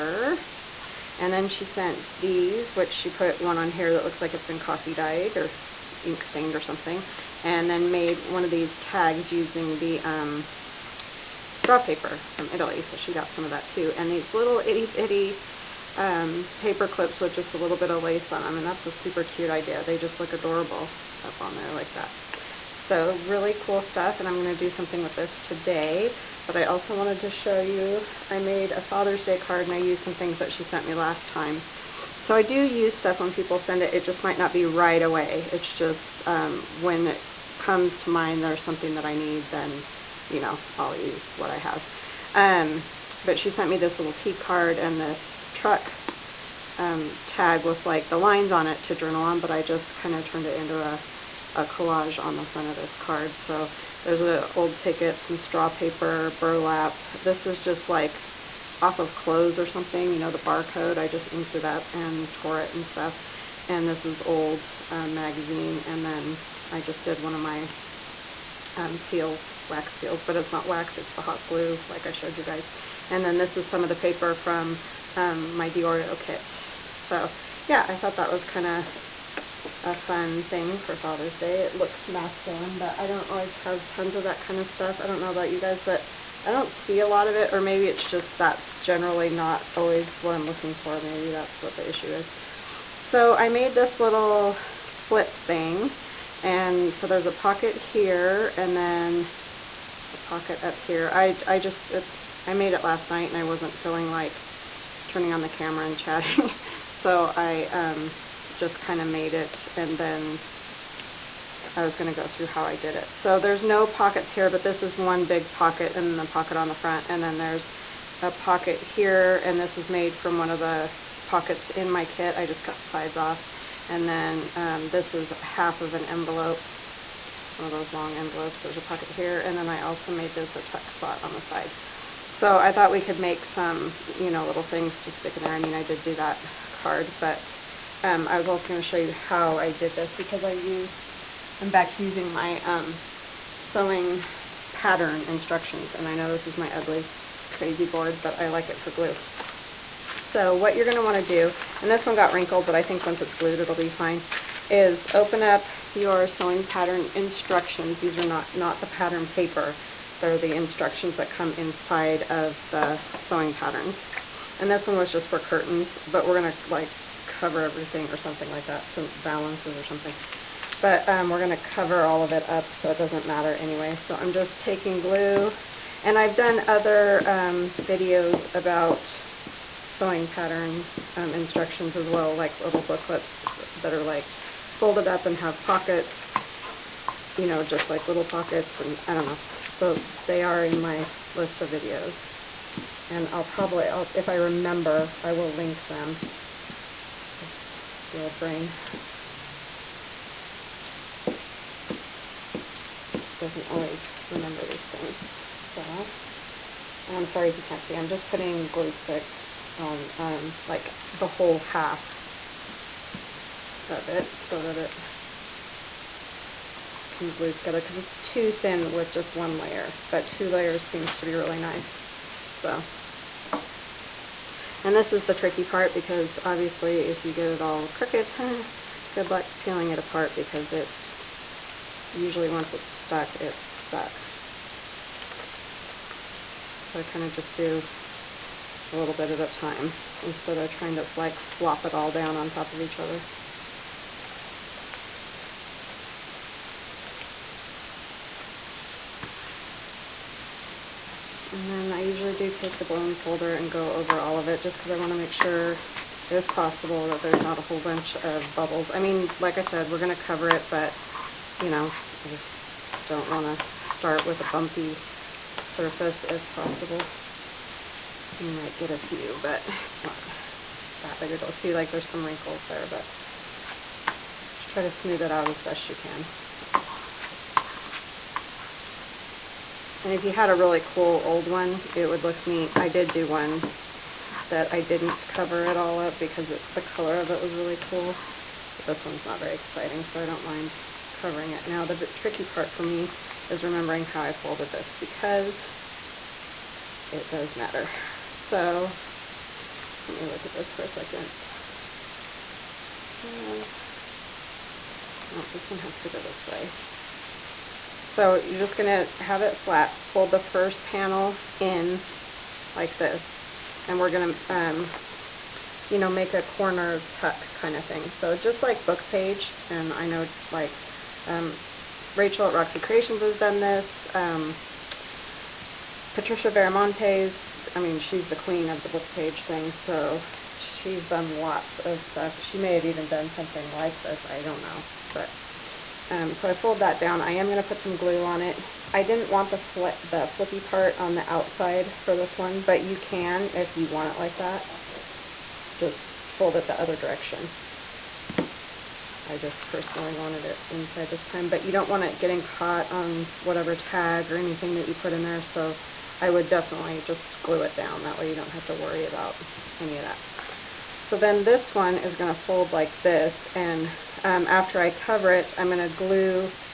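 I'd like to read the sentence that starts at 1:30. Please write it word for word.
Maybe that's what the issue is.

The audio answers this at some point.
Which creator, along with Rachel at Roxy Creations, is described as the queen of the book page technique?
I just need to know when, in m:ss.
5:26.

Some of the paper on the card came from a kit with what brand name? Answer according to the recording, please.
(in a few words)
Diorio.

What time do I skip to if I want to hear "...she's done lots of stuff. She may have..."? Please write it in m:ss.
5:30.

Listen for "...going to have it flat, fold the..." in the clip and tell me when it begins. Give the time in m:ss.
5:08.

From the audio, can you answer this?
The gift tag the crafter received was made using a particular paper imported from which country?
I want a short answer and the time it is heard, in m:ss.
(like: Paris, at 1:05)
Italy, at 0:12.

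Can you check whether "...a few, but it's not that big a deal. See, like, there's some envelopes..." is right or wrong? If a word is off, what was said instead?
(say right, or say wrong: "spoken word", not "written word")
wrong: "wrinkles", not "envelopes".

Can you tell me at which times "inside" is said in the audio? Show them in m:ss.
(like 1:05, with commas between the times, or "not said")
2:41, 5:50.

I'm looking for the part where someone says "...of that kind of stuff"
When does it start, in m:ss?
1:24.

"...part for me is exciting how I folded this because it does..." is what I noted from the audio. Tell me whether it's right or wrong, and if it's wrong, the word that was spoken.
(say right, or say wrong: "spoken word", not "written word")
wrong: "remembering", not "exciting".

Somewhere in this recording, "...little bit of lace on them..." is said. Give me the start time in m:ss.
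0:17.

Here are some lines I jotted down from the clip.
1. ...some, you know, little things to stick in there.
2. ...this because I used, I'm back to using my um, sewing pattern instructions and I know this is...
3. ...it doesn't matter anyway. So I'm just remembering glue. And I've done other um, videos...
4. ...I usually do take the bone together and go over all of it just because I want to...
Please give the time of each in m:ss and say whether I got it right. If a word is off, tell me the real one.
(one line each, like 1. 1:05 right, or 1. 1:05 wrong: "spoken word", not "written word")
1. 2:13 right
2. 2:19 right
3. 2:52 wrong: "taking", not "remembering"
4. 4:11 wrong: "folder", not "together".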